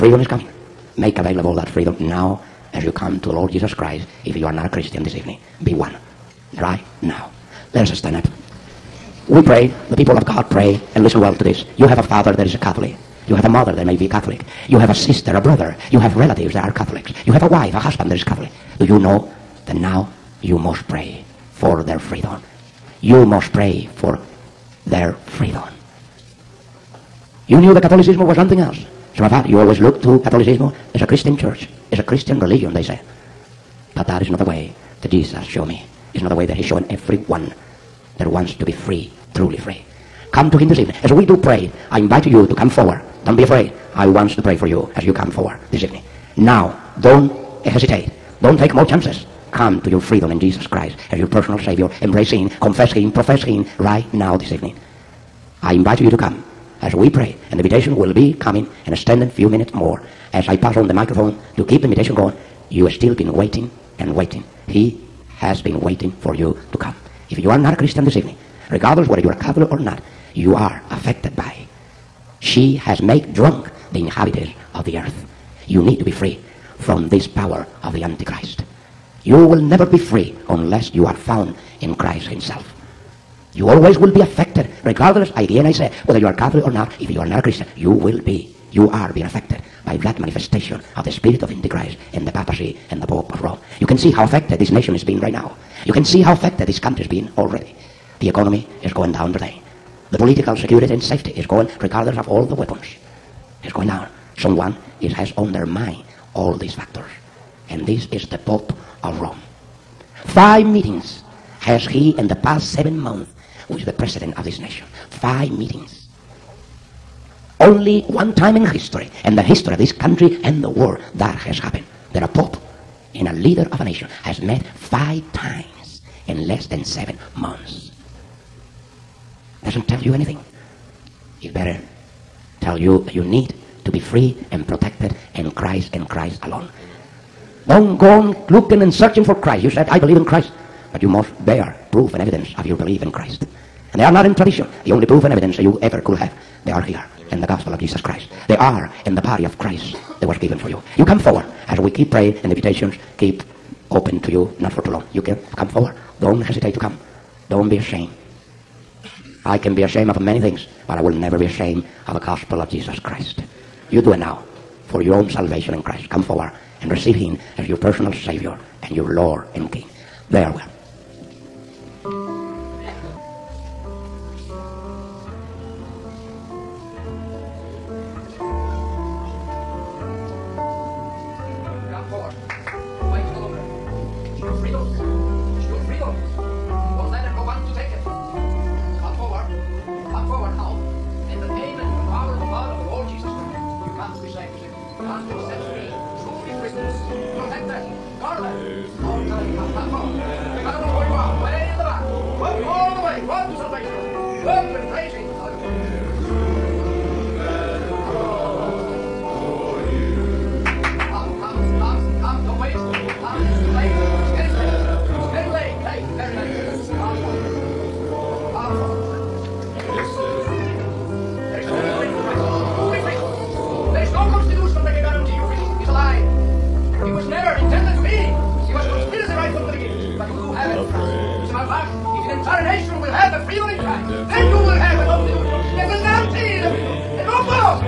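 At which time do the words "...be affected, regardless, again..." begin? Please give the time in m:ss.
1:24.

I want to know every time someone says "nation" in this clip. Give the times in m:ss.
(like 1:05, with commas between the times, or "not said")
1:34, 1:54, 2:03.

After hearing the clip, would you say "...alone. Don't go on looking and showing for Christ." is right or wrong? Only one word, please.
wrong.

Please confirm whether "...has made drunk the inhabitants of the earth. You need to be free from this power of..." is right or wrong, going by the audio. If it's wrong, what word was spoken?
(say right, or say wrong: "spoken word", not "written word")
right.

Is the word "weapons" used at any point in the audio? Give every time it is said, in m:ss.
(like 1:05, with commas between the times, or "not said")
1:42.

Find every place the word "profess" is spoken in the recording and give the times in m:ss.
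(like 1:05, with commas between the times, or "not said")
0:53.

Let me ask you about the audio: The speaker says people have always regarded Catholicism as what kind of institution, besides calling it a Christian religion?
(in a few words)
a Christian church.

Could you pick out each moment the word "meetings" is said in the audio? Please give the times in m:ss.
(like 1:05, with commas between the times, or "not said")
1:50, 1:55.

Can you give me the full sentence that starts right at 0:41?
As we do pray, I invite you to come forward.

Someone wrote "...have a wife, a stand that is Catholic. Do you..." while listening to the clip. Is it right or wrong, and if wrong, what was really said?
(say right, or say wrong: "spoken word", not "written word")
wrong: "husband", not "stand".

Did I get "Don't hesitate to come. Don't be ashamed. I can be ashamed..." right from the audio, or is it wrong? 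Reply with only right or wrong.
right.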